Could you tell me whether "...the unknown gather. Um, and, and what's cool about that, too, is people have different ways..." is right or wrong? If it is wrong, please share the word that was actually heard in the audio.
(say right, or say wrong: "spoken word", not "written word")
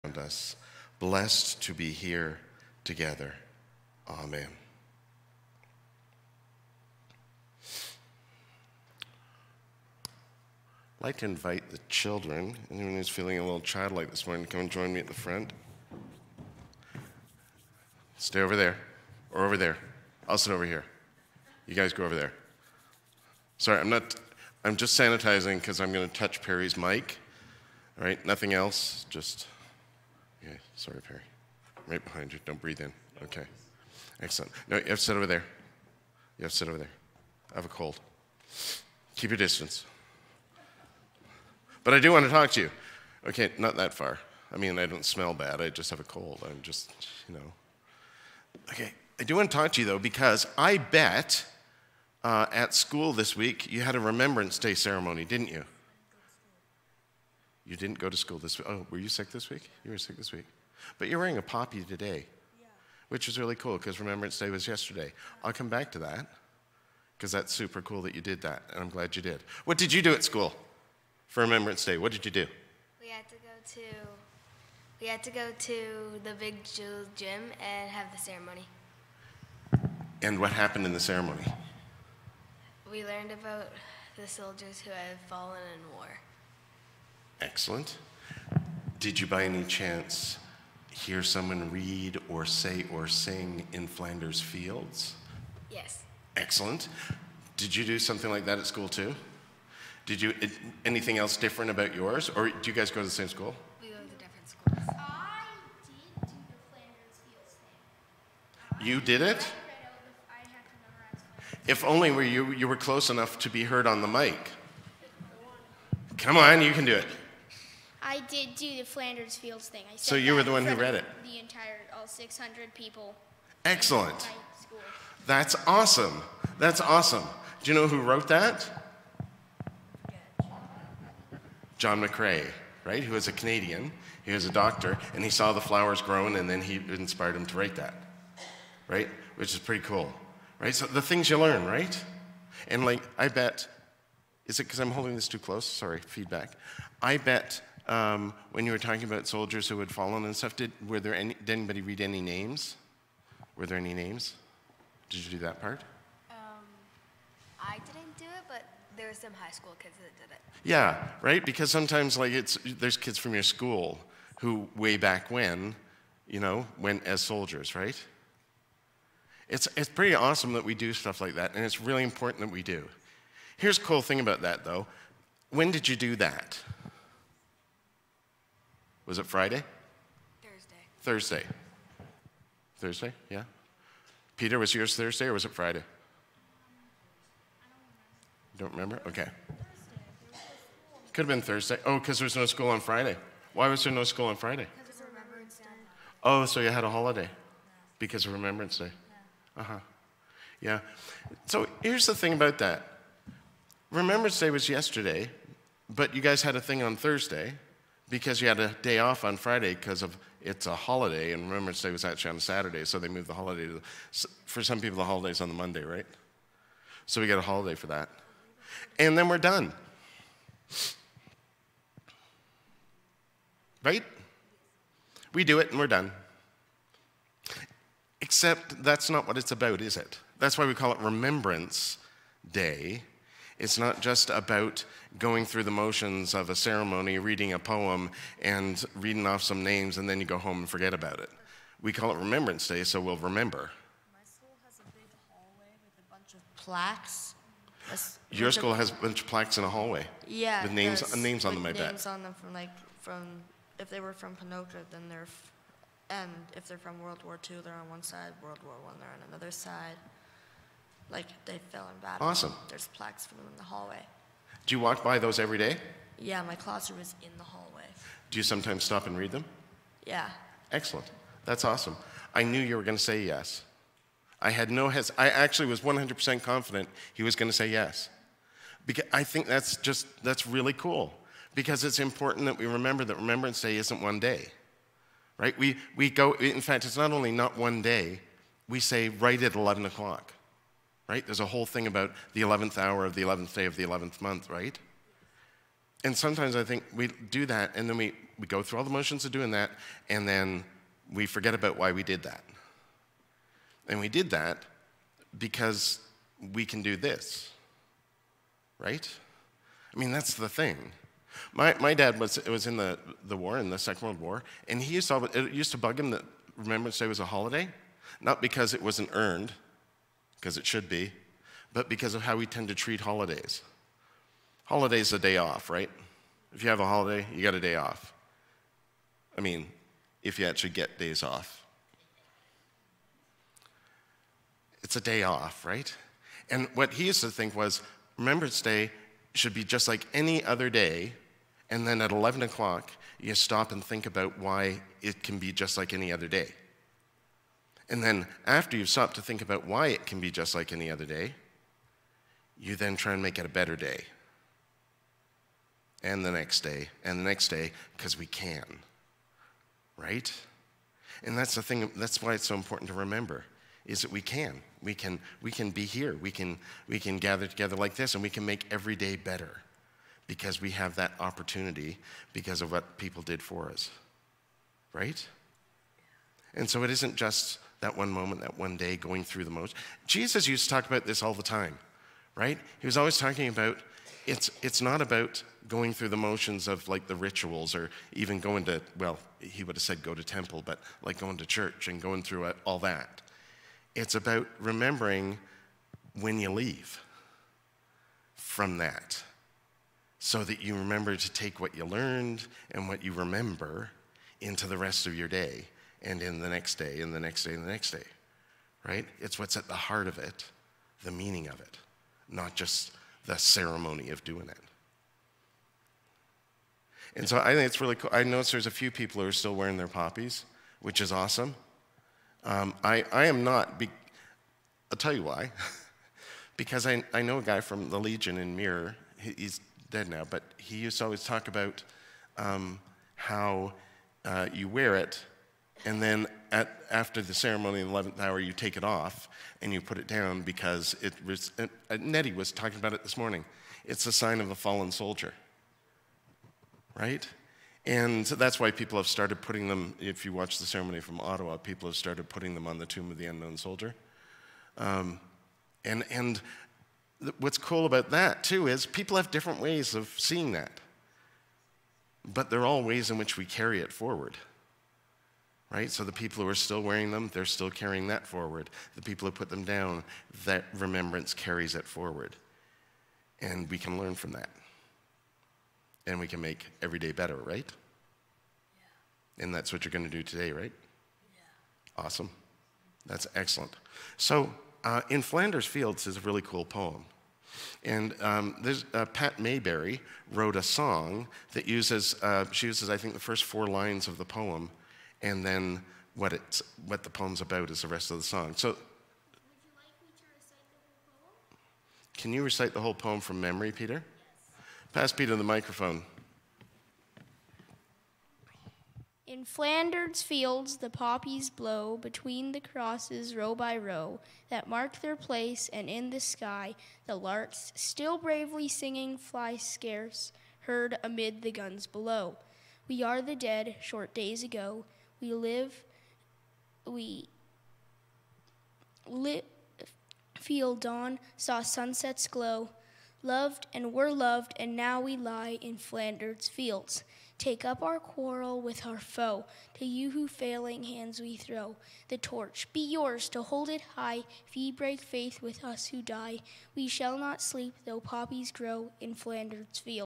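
wrong: "soldier", not "gather".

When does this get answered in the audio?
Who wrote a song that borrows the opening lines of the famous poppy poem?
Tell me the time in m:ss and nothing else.
8:09.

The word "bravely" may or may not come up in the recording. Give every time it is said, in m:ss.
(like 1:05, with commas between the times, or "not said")
8:38.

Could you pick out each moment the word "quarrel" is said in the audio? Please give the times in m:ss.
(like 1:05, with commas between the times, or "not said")
8:57.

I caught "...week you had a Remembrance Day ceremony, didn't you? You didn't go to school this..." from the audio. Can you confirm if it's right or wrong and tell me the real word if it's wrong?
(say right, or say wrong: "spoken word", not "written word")
right.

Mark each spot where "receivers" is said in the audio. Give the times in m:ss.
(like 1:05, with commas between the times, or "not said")
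not said.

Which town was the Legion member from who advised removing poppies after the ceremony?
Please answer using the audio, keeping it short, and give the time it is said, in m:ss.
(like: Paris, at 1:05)
Mirror, at 7:08.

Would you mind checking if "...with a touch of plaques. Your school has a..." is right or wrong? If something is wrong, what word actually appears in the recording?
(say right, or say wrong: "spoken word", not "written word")
wrong: "bunch", not "touch".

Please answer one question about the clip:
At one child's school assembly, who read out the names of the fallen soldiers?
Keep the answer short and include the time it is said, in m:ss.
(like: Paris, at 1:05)
High school kids, at 2:39.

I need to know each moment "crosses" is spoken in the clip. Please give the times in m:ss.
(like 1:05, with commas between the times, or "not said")
8:32.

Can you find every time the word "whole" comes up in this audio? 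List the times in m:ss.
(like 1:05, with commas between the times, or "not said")
4:51, 8:22.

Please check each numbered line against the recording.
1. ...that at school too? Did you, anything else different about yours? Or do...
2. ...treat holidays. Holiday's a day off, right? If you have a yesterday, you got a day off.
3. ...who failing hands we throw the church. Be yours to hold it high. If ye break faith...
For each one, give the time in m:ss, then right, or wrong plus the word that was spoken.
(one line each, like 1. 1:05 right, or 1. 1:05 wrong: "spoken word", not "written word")
1. 1:38 right
2. 5:22 wrong: "holiday", not "yesterday"
3. 9:00 wrong: "torch", not "church".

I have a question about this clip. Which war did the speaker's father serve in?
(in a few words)
Second World War.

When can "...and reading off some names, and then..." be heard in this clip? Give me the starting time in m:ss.
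3:58.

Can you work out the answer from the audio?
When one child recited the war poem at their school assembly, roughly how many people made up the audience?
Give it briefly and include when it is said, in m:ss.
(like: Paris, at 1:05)
600, at 2:02.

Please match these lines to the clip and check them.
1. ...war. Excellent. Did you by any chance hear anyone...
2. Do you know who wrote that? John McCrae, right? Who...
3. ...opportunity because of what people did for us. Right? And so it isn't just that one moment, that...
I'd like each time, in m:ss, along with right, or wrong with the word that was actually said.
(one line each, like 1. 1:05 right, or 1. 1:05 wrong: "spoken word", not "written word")
1. 1:25 wrong: "someone", not "anyone"
2. 2:07 right
3. 6:11 right.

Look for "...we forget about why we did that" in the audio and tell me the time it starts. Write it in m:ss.
5:01.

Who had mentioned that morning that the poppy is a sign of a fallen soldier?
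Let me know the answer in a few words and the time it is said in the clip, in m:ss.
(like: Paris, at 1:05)
Nettie, at 7:21.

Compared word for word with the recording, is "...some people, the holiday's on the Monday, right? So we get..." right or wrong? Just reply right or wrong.
right.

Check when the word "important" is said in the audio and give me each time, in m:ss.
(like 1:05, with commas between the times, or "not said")
2:52, 4:41, 6:02.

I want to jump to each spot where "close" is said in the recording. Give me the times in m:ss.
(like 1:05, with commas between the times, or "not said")
1:52, 2:25.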